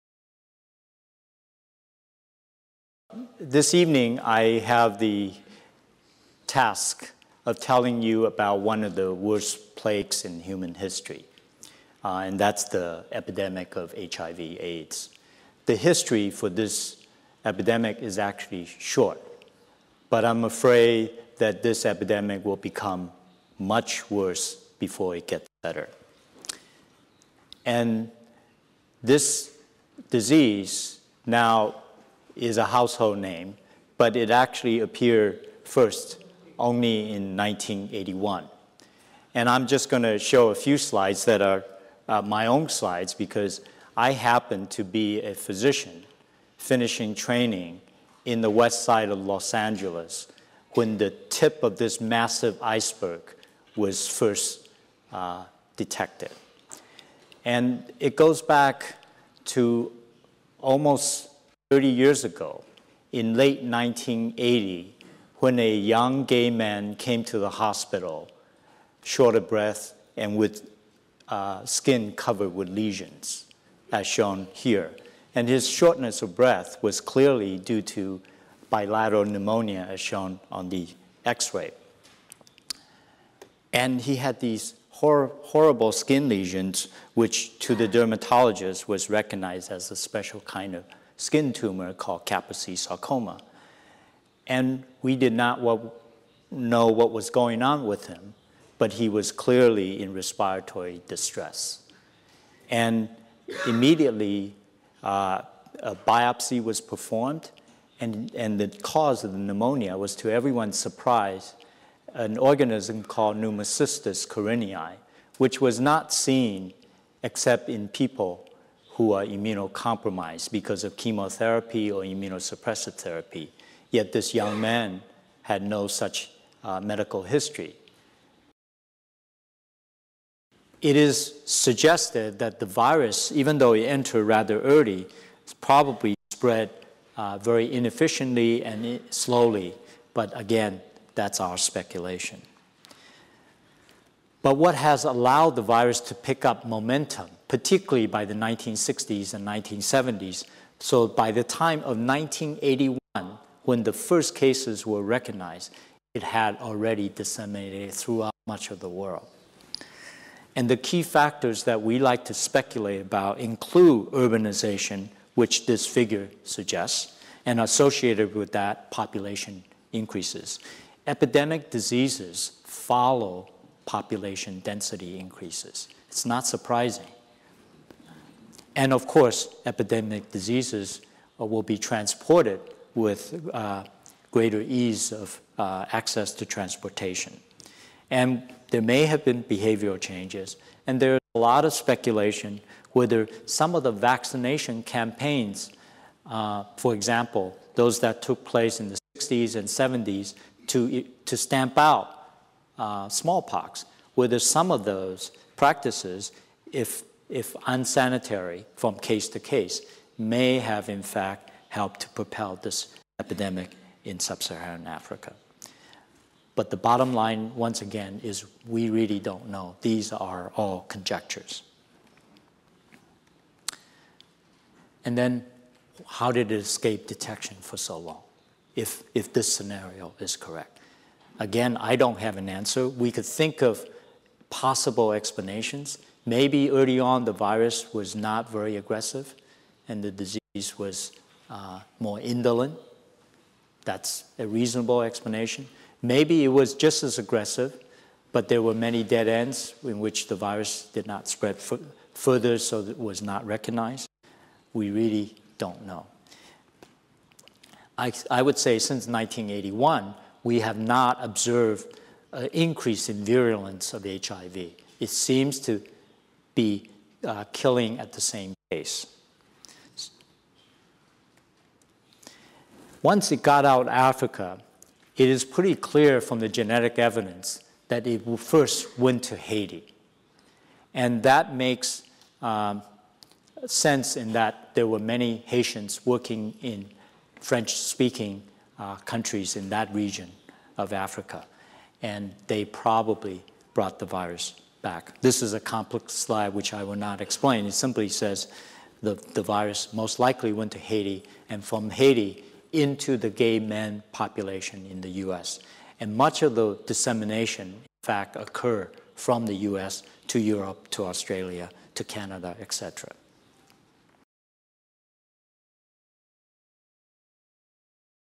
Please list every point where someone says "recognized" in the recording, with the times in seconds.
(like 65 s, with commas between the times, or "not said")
89 s, 155 s, 253 s.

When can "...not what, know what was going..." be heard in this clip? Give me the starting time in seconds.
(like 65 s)
95 s.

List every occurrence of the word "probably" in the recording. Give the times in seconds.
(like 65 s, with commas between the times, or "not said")
135 s, 292 s.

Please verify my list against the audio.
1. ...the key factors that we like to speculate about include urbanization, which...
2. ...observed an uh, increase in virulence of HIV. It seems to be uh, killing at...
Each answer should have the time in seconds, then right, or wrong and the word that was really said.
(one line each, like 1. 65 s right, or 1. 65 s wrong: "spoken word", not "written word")
1. 160 s right
2. 261 s right.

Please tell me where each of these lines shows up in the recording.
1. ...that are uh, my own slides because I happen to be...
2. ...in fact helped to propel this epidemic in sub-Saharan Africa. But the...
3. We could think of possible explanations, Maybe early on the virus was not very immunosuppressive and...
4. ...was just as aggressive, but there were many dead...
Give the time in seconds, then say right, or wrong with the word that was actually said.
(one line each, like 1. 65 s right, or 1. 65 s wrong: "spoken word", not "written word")
1. 41 s right
2. 210 s right
3. 232 s wrong: "aggressive", not "immunosuppressive"
4. 246 s right.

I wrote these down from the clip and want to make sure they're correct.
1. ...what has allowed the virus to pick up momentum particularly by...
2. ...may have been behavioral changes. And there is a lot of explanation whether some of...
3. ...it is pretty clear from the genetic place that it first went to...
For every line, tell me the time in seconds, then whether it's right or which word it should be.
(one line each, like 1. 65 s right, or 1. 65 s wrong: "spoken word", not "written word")
1. 144 s right
2. 188 s wrong: "speculation", not "explanation"
3. 275 s wrong: "evidence", not "place".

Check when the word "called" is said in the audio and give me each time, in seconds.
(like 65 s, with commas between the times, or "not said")
91 s, 113 s.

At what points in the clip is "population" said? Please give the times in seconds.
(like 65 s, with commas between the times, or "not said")
168 s, 173 s, 304 s.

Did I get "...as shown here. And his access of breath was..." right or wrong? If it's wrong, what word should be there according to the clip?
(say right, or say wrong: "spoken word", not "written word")
wrong: "shortness", not "access".